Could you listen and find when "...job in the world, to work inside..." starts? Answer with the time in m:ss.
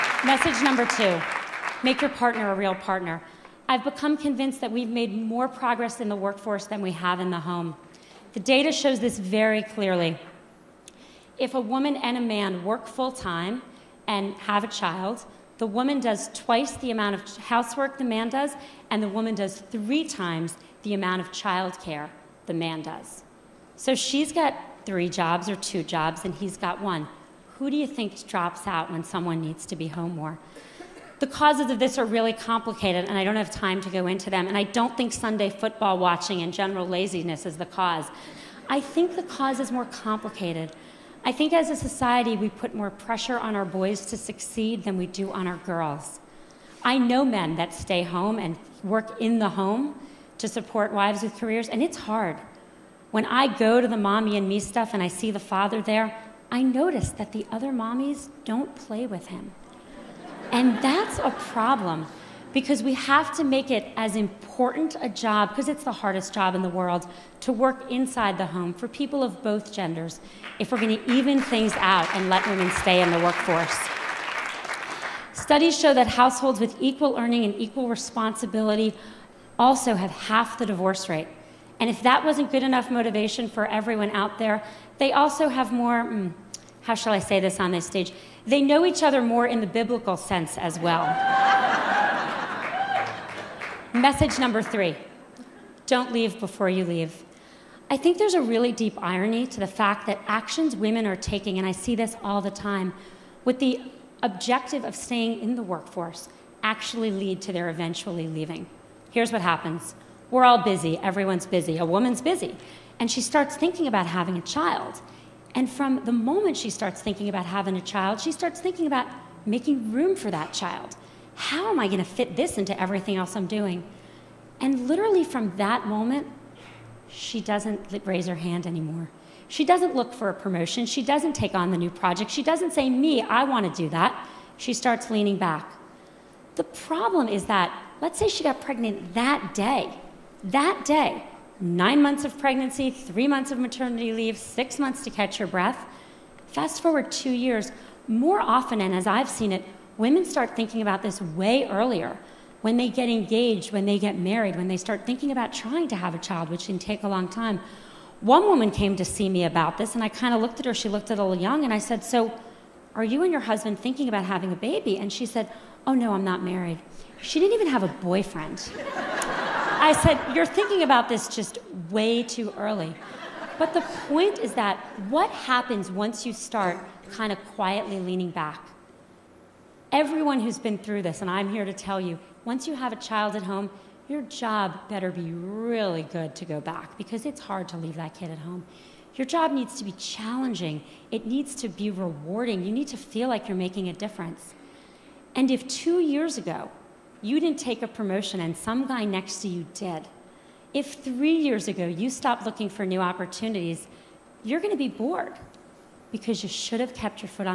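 1:06.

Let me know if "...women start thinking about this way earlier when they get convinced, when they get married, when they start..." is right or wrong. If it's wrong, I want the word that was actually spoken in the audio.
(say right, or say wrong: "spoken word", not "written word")
wrong: "engaged", not "convinced".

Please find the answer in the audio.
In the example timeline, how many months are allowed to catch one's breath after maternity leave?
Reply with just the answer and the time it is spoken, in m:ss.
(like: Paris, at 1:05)
6, at 2:24.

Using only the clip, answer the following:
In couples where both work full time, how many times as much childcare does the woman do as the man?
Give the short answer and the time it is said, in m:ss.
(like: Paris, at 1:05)
3 times, at 0:19.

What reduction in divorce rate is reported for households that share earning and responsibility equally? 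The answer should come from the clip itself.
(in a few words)
half.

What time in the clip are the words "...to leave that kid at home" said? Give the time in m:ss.
3:07.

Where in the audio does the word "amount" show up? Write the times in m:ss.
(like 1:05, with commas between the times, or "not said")
0:16, 0:20.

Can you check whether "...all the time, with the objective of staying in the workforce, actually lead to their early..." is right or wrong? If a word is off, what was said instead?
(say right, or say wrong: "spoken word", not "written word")
wrong: "eventually", not "early".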